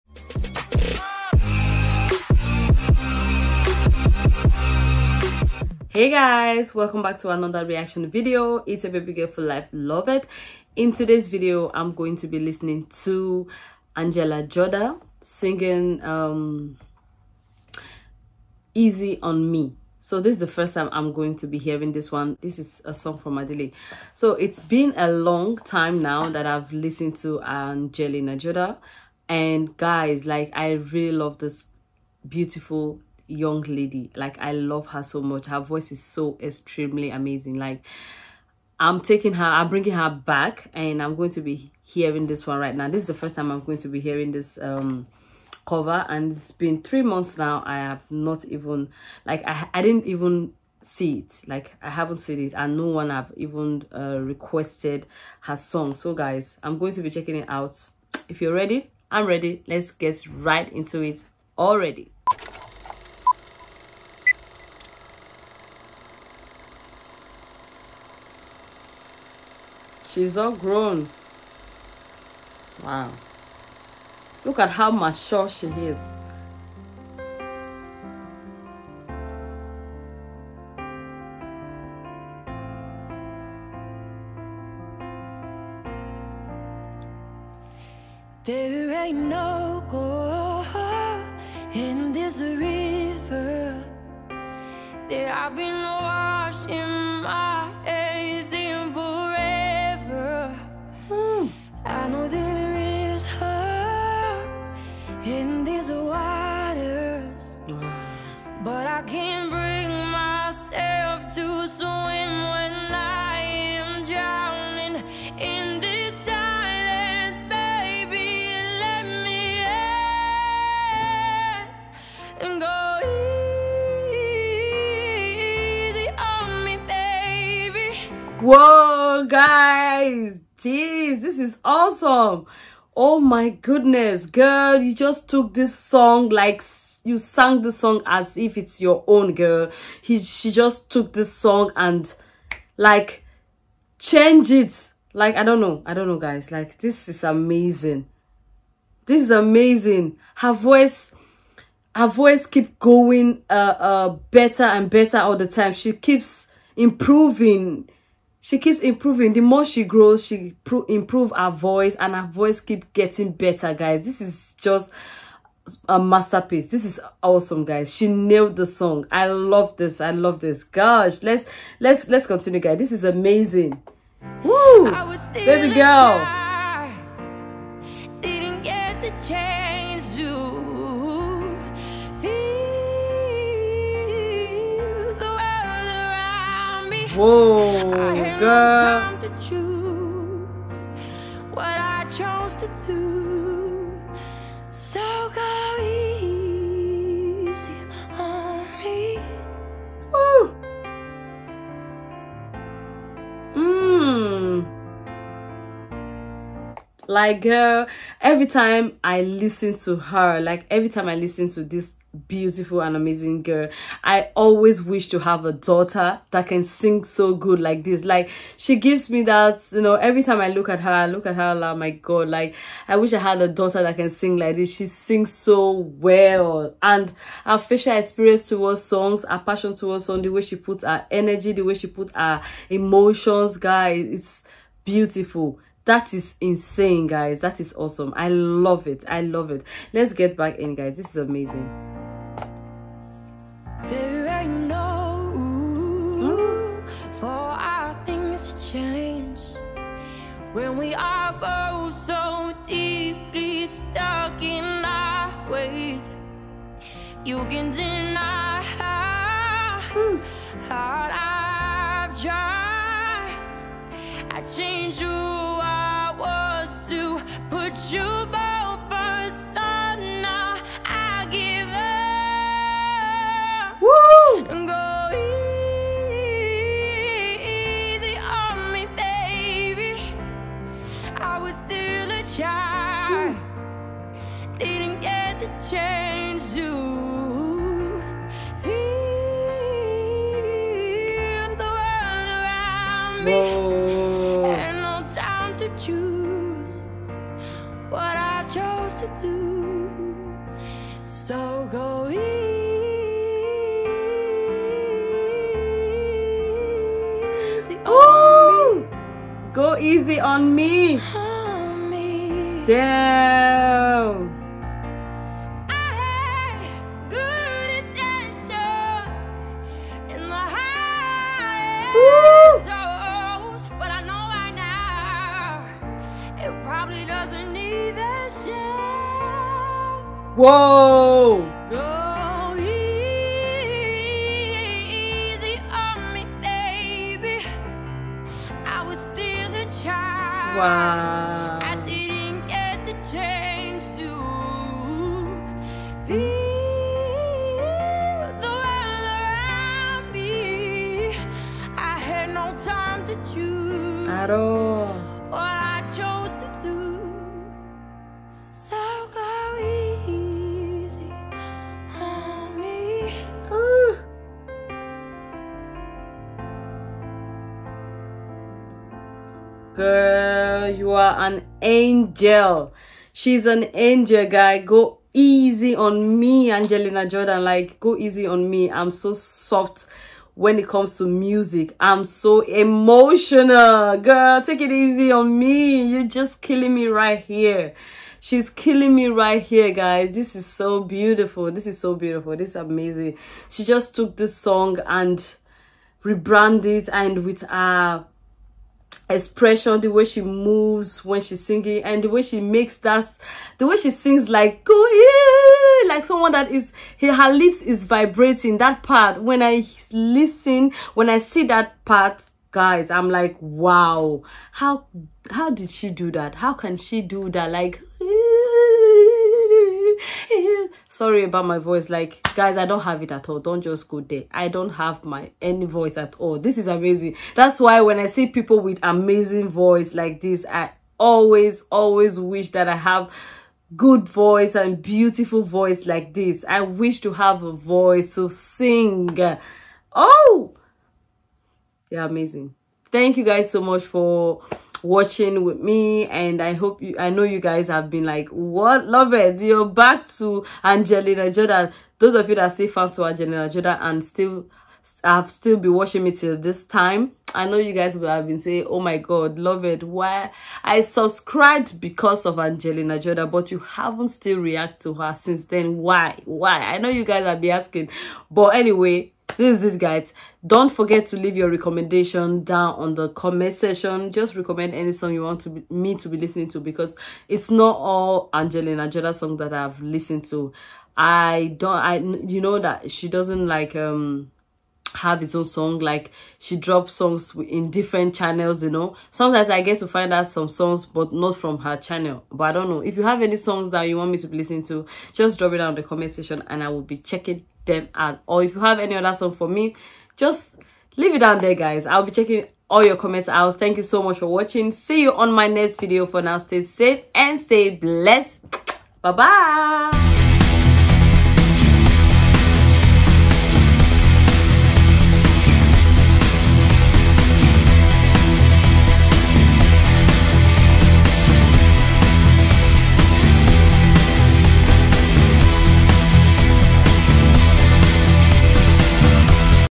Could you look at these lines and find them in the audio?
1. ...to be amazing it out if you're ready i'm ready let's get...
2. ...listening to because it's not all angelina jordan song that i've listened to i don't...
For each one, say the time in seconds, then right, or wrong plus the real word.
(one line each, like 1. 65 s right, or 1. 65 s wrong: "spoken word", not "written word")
1. 56 s wrong: "checking", not "amazing"
2. 476 s right.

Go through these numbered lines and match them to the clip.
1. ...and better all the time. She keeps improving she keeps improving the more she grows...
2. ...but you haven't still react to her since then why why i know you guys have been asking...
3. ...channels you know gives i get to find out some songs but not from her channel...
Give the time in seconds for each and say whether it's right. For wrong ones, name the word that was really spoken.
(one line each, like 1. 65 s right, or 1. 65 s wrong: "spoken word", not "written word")
1. 154 s right
2. 463 s right
3. 488 s wrong: "sometimes", not "gives".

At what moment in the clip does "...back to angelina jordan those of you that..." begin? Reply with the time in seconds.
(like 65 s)
449 s.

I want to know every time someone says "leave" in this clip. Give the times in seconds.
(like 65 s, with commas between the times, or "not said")
471 s, 500 s.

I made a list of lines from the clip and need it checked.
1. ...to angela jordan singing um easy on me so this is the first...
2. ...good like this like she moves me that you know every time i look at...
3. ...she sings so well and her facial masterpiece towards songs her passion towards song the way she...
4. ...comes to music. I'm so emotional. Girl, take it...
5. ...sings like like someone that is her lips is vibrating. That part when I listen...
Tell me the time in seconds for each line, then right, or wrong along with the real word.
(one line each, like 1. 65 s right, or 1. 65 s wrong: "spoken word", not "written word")
1. 12 s right
2. 217 s wrong: "gives", not "moves"
3. 224 s wrong: "experience", not "masterpiece"
4. 380 s right
5. 403 s right.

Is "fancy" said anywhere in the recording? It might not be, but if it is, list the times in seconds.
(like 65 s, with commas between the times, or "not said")
not said.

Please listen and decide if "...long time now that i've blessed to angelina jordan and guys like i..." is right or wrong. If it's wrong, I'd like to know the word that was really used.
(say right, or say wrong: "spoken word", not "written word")
wrong: "listened", not "blessed".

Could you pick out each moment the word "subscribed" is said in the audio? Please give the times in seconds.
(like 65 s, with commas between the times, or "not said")
460 s.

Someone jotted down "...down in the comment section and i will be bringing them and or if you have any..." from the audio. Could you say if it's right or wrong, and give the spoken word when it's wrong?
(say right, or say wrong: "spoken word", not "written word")
wrong: "checking", not "bringing".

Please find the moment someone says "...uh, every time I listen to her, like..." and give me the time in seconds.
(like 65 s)
207 s.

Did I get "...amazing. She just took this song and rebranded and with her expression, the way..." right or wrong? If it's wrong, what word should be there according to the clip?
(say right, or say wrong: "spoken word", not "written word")
right.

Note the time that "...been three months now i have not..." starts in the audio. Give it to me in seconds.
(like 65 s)
46 s.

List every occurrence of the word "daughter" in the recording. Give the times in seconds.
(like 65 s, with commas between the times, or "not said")
215 s, 223 s.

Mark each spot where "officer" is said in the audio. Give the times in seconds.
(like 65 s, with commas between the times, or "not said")
not said.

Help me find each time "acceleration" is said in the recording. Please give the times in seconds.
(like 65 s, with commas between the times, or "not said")
not said.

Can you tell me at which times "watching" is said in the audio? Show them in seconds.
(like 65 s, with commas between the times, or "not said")
444 s, 455 s, 504 s.